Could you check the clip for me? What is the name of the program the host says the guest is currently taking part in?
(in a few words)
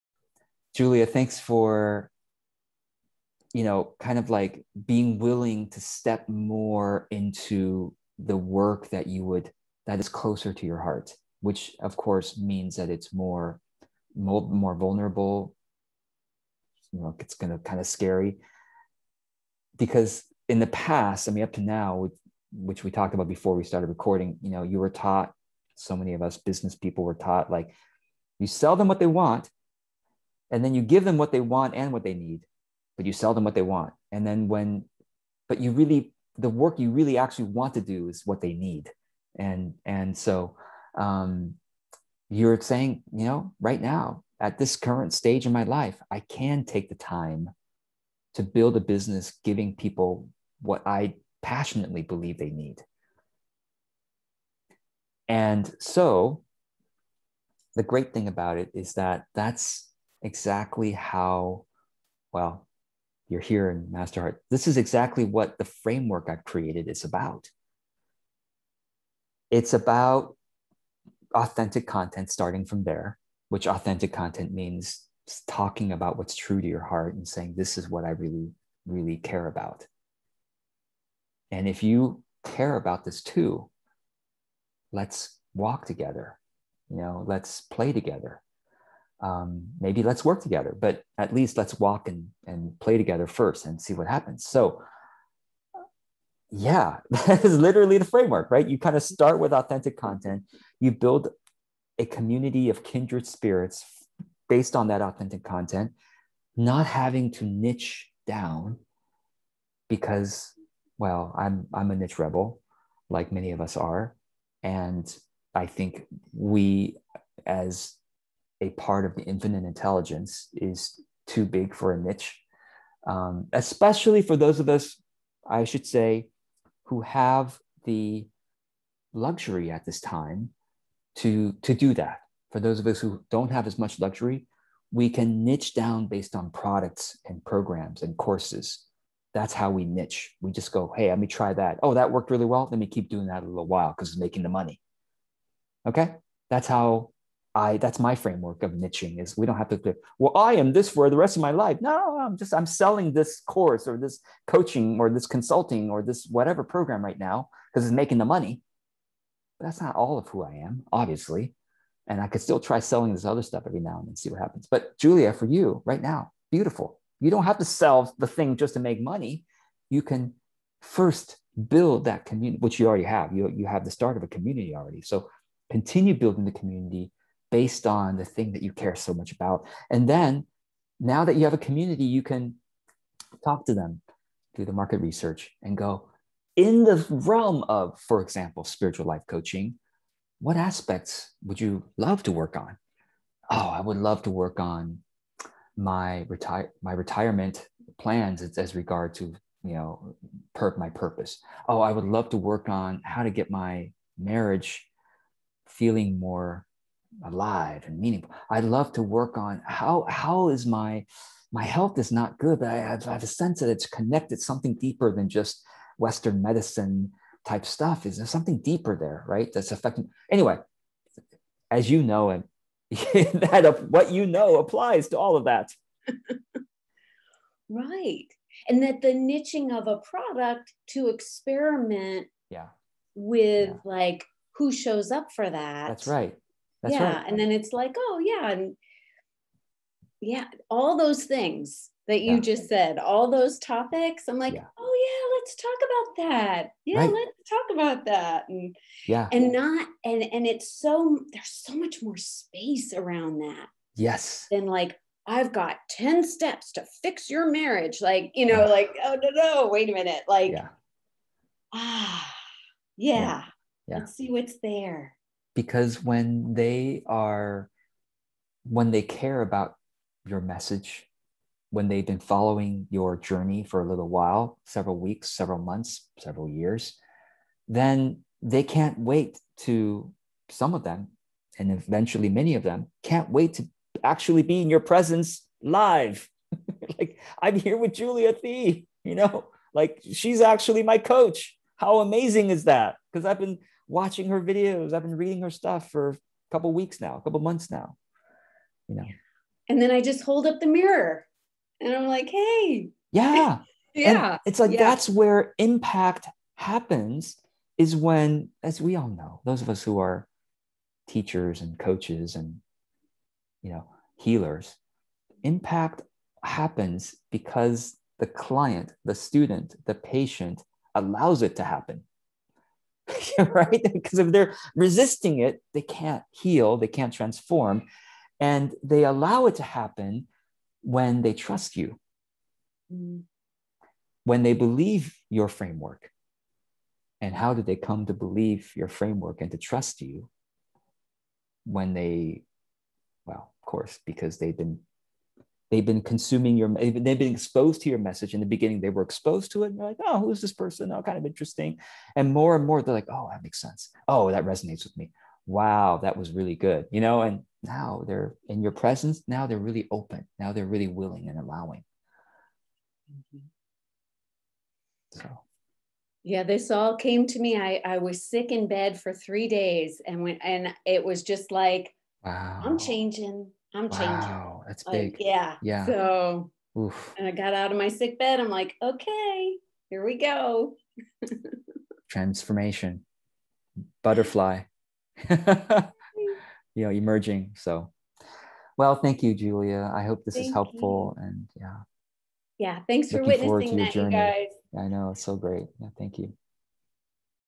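MasterHeart.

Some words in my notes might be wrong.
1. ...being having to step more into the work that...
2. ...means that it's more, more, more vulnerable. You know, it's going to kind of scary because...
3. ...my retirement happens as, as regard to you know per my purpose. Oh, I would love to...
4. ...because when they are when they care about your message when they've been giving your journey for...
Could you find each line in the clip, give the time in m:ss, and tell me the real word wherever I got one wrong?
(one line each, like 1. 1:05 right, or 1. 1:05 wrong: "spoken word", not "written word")
1. 0:04 wrong: "willing", not "having"
2. 0:12 right
3. 3:16 wrong: "plans", not "happens"
4. 4:25 wrong: "following", not "giving".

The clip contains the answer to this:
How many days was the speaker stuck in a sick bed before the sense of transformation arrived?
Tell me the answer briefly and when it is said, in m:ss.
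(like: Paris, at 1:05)
3, at 6:09.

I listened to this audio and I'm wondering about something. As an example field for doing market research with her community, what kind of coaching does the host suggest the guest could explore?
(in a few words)
spiritual life coaching.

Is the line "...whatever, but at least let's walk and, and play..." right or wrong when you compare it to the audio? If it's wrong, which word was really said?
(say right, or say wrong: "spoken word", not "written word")
wrong: "together", not "whatever".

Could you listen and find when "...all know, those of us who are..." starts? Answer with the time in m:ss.
5:08.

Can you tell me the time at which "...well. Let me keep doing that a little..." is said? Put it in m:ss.
2:22.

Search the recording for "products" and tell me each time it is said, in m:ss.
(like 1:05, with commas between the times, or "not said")
2:16, 3:49.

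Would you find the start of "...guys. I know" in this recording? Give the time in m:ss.
6:34.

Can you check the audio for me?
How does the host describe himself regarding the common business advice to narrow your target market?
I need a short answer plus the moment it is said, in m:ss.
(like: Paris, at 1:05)
niche rebel, at 1:51.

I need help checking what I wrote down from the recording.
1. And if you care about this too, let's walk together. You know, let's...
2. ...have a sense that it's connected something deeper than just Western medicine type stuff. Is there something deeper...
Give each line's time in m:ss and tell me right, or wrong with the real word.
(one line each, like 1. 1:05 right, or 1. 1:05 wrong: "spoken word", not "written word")
1. 1:21 right
2. 3:33 right.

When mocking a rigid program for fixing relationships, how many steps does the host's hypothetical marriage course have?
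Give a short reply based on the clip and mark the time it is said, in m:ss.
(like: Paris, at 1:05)
10, at 4:15.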